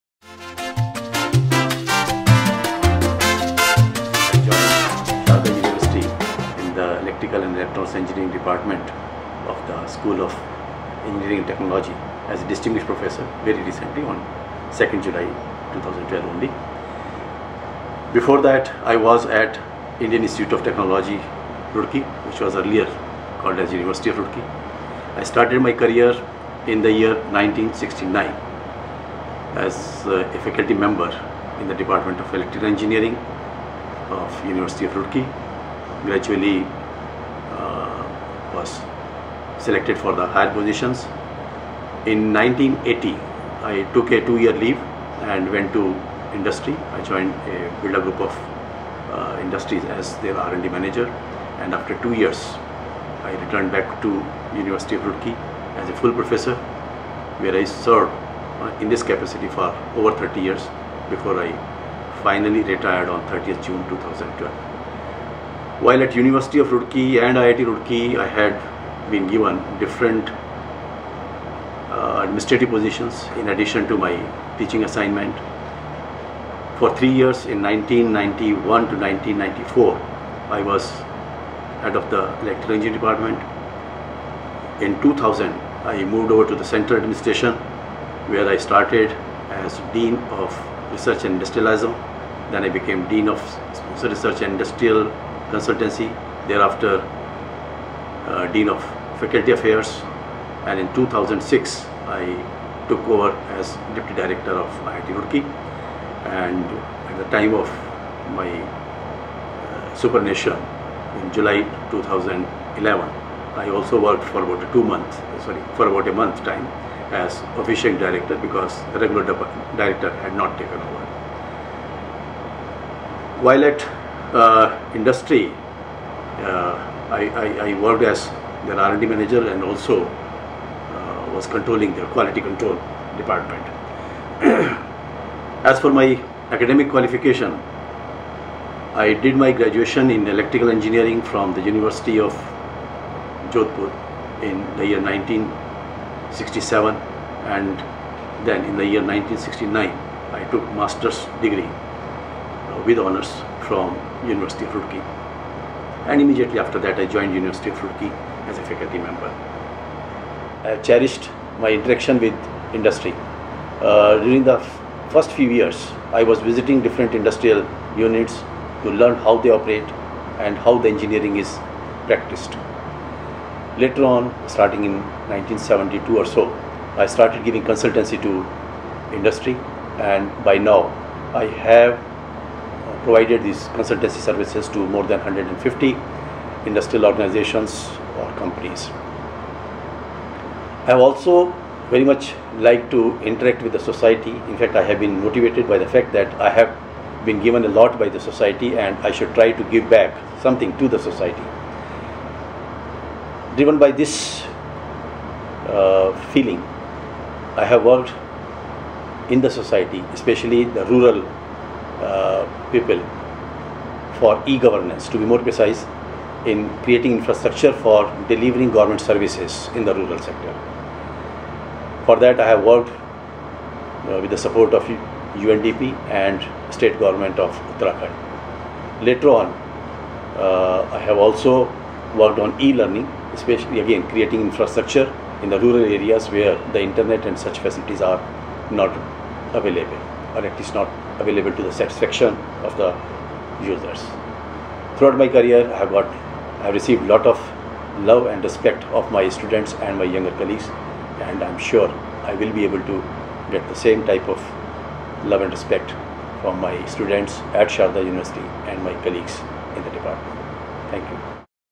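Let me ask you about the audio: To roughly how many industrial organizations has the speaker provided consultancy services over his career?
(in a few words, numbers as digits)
More than 150.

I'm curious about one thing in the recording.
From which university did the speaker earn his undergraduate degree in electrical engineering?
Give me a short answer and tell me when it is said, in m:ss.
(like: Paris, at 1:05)
University of Jodhpur, at 2:21.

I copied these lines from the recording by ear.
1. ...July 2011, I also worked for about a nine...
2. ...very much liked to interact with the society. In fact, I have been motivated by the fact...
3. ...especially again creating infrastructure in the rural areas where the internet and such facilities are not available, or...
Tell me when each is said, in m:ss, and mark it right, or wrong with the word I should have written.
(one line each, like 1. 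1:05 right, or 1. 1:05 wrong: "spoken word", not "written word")
1. 1:51 wrong: "two", not "nine"
2. 3:11 right
3. 3:53 right.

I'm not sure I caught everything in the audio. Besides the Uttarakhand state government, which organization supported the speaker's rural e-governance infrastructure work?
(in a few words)
UNDP.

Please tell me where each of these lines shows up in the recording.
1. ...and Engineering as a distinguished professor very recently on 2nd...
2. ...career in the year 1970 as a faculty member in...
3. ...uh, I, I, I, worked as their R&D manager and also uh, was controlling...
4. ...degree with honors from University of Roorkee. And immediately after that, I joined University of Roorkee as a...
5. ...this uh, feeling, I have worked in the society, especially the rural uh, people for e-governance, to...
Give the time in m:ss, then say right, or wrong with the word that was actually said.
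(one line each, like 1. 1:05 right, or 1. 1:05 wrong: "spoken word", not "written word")
1. 0:11 wrong: "Technology", not "Engineering"
2. 0:25 wrong: "1969", not "1970"
3. 2:05 right
4. 2:31 right
5. 3:23 right.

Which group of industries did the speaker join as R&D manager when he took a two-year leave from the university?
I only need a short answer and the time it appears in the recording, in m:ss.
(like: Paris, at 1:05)
Birla group, at 0:47.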